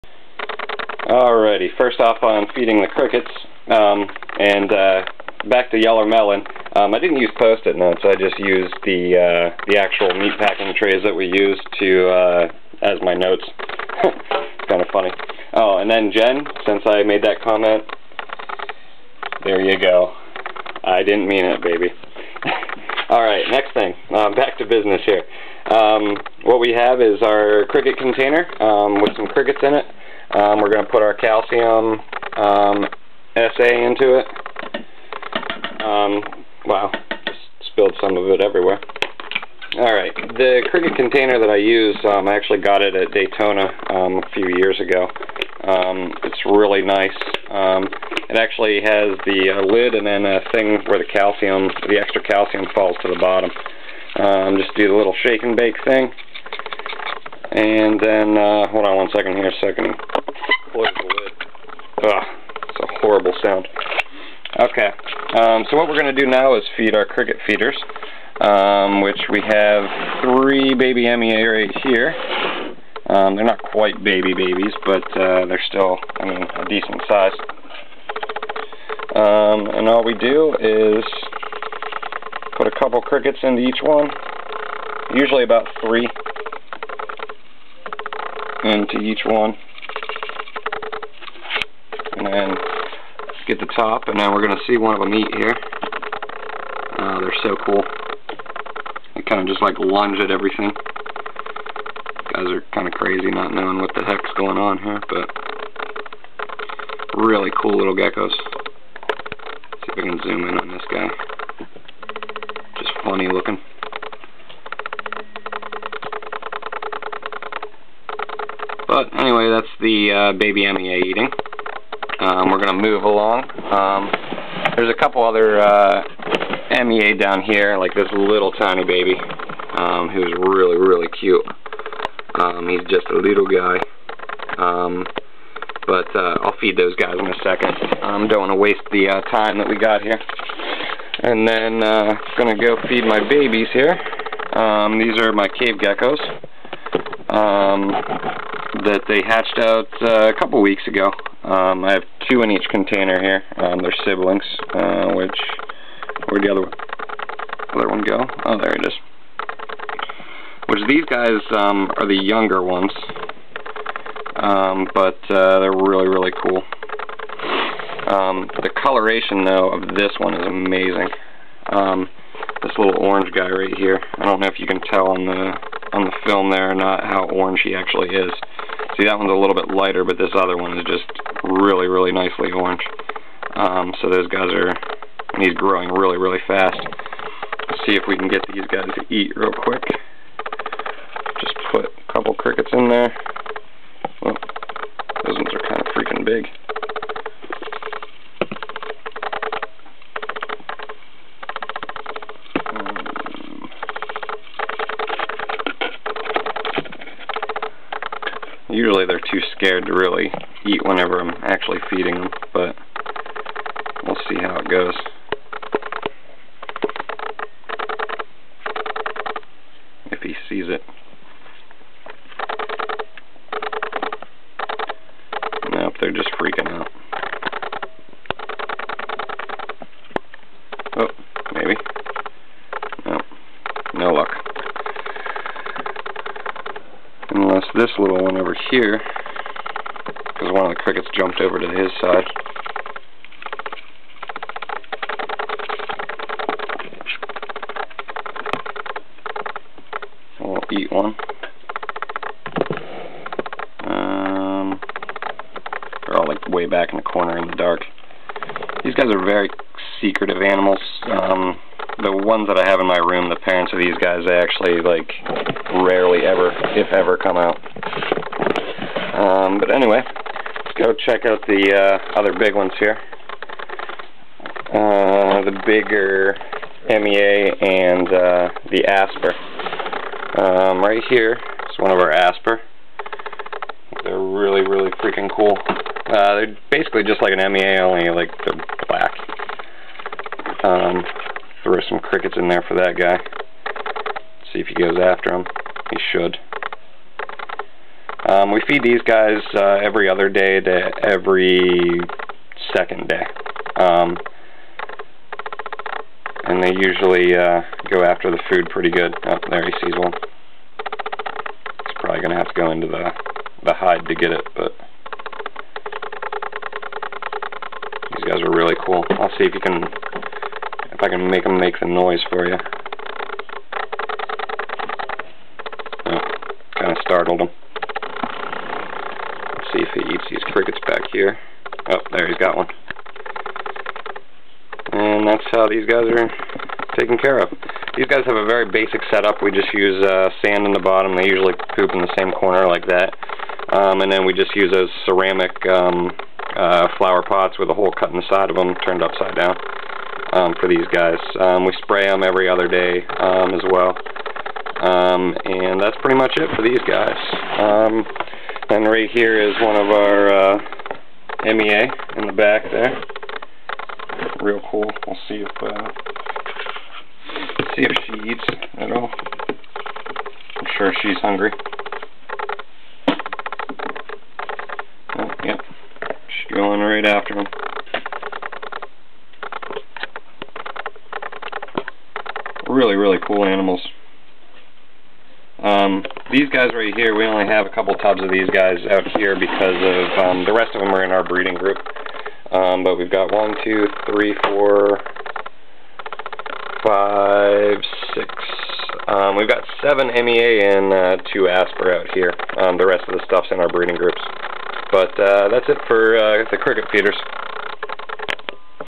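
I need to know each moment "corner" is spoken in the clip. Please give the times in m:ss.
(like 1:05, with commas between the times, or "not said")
4:17, 5:42.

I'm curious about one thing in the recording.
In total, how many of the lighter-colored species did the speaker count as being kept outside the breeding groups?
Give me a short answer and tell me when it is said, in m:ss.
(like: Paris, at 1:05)
7, at 6:39.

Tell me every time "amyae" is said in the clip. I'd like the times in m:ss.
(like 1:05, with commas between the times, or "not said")
1:11, 2:00, 2:06, 4:36, 4:47, 6:01, 6:40.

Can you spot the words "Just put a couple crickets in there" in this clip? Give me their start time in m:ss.
3:11.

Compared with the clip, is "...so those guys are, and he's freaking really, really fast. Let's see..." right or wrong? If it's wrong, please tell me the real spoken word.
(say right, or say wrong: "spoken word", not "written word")
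wrong: "growing", not "freaking".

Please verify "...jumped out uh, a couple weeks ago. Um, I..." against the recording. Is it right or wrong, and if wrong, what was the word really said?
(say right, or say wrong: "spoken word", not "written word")
wrong: "hatched", not "jumped".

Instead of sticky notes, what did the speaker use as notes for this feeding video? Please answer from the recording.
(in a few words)
meat packing trays.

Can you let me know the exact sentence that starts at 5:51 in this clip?
Um, we spray them every other day um, as well.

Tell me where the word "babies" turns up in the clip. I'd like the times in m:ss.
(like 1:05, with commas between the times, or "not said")
1:14, 2:23.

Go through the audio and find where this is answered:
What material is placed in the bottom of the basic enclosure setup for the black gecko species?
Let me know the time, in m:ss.
5:40.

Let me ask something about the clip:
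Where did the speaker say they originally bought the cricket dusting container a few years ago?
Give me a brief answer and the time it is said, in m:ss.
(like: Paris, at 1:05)
Daytona, at 0:43.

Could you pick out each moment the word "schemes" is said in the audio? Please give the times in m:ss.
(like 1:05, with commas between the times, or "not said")
not said.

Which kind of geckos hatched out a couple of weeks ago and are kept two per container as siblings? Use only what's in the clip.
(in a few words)
cave geckos.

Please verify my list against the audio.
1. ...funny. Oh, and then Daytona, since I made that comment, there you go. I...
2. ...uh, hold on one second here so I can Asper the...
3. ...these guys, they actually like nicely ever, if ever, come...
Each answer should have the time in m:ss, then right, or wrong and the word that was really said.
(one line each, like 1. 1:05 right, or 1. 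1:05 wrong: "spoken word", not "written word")
1. 0:14 wrong: "Jen", not "Daytona"
2. 0:58 wrong: "Close", not "Asper"
3. 4:23 wrong: "rarely", not "nicely".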